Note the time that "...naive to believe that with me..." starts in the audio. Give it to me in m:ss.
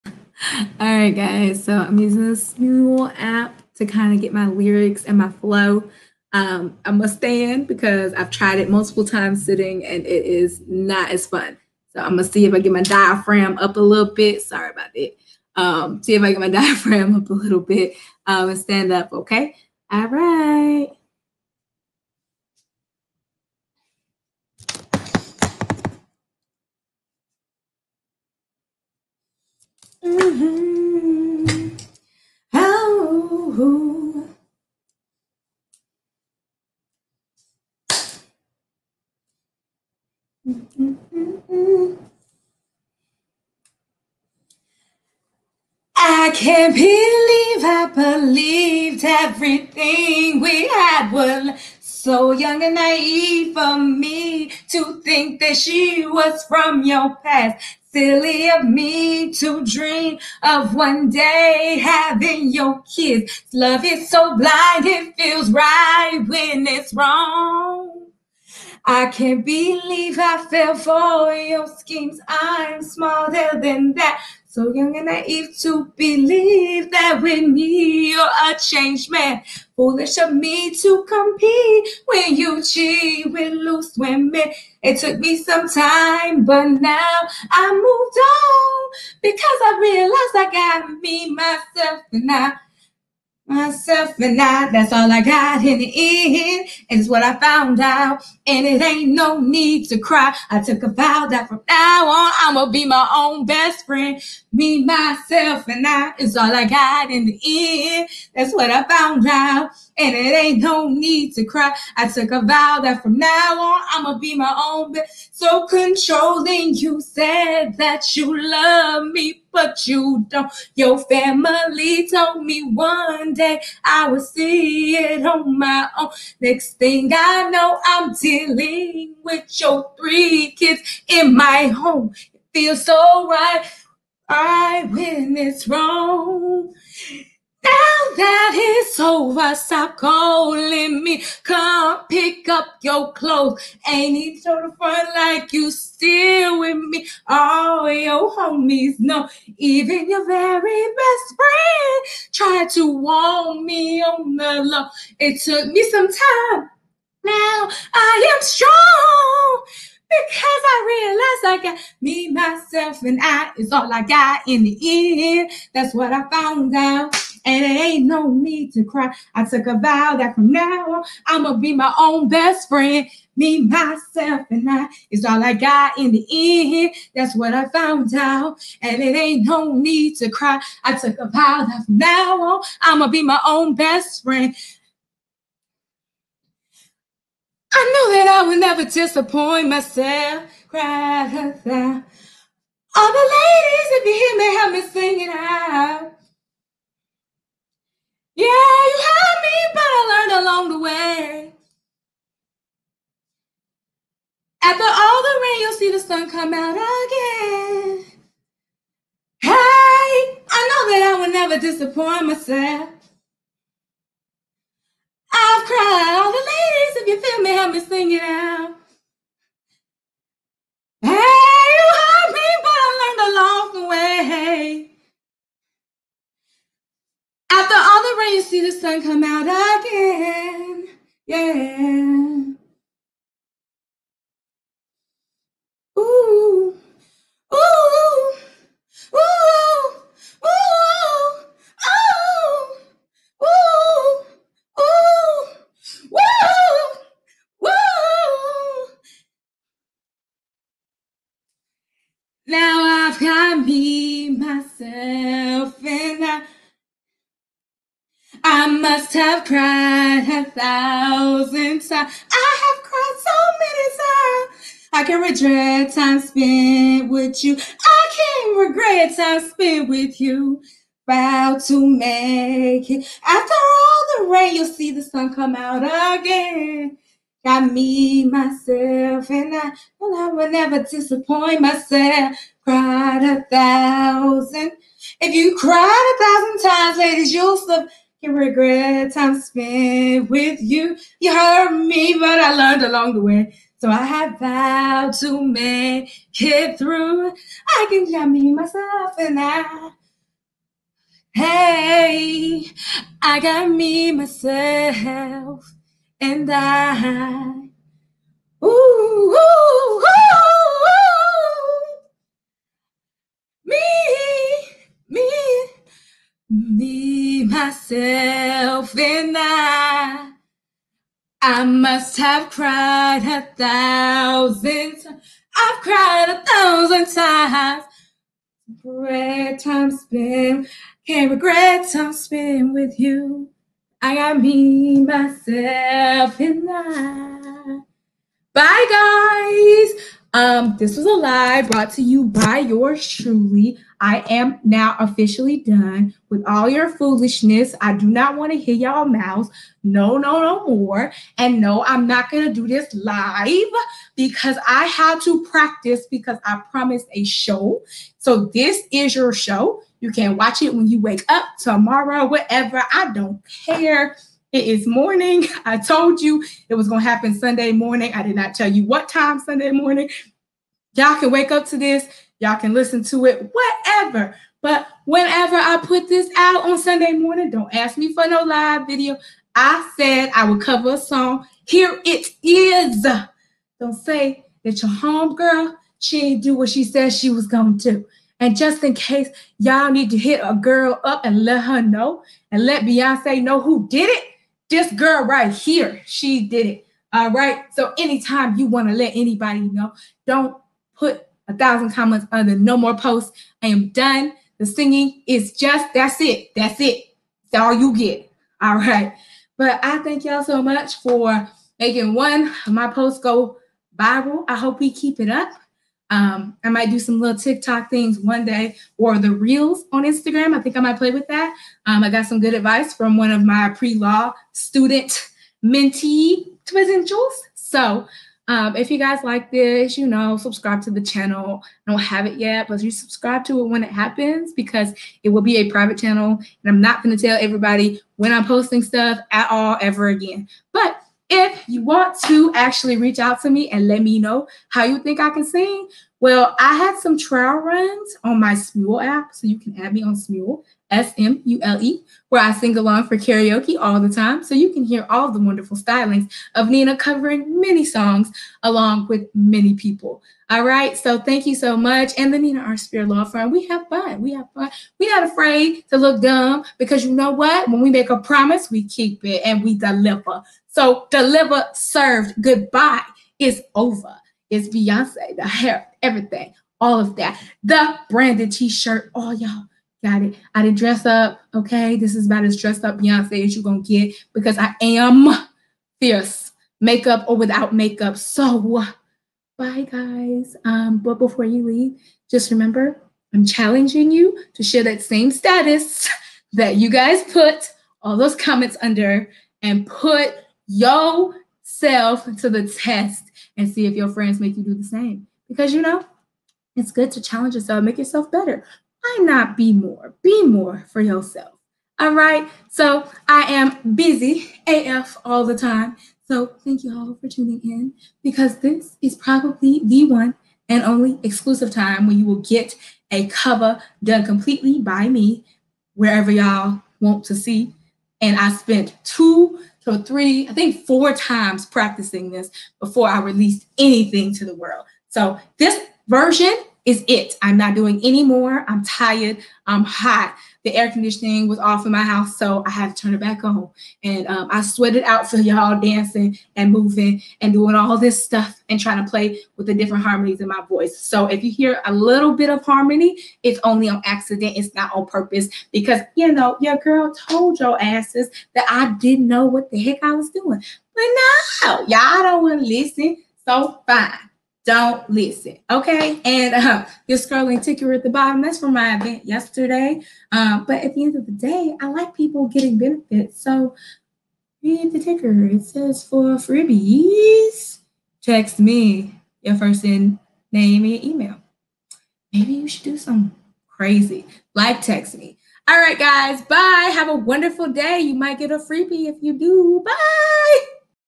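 1:15.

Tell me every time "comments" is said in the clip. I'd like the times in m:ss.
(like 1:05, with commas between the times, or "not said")
6:41, 8:18.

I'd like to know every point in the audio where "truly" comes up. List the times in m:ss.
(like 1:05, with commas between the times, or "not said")
5:43.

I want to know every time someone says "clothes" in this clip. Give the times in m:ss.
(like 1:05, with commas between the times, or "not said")
2:23.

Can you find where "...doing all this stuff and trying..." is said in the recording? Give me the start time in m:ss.
9:07.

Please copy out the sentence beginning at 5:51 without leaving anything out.
And no, I'm not going to do this live because I had to practice because I promised a show.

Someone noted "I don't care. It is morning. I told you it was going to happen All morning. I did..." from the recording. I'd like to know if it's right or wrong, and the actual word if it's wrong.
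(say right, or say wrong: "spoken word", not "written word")
wrong: "Sunday", not "All".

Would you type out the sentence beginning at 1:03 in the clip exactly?
Love is so blind, it feels right when it's wrong.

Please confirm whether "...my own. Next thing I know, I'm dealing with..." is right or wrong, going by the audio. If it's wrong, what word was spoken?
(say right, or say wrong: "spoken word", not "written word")
right.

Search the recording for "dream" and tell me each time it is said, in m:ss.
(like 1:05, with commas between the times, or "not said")
0:59.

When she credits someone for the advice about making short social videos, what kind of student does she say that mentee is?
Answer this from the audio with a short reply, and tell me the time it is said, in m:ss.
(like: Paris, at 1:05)
pre law student, at 7:03.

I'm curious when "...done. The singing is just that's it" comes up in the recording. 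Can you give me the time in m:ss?
6:43.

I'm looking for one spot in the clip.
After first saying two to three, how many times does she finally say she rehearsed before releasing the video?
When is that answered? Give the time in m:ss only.
8:50.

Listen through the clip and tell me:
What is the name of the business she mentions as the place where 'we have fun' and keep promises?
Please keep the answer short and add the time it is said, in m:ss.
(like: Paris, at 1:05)
Neena R. Speer Law Firm, at 7:42.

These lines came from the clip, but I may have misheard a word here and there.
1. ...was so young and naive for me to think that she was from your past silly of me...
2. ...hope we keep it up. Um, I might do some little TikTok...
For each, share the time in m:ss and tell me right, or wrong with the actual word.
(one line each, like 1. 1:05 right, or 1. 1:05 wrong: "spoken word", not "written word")
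1. 0:51 right
2. 6:54 right.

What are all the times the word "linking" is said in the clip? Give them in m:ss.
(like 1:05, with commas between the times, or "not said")
not said.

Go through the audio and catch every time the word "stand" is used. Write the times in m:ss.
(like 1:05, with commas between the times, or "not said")
0:07, 0:18.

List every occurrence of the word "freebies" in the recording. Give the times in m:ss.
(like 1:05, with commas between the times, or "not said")
9:36, 9:48.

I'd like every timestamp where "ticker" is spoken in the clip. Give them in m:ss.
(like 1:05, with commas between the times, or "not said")
9:27, 9:34.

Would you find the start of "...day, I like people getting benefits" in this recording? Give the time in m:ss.
9:31.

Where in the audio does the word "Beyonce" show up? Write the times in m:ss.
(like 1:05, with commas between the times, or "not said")
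6:32, 7:54, 8:02.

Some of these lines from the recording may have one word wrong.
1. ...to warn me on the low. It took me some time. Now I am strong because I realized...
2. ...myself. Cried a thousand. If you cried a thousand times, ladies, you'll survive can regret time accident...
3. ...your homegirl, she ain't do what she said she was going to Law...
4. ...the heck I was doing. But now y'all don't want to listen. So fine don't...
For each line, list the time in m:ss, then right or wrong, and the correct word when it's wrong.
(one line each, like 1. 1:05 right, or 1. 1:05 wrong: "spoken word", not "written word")
1. 2:32 right
2. 4:41 wrong: "spent", not "accident"
3. 6:24 wrong: "And", not "Law"
4. 9:19 right.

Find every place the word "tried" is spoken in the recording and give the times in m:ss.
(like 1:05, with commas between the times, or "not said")
0:08, 2:32.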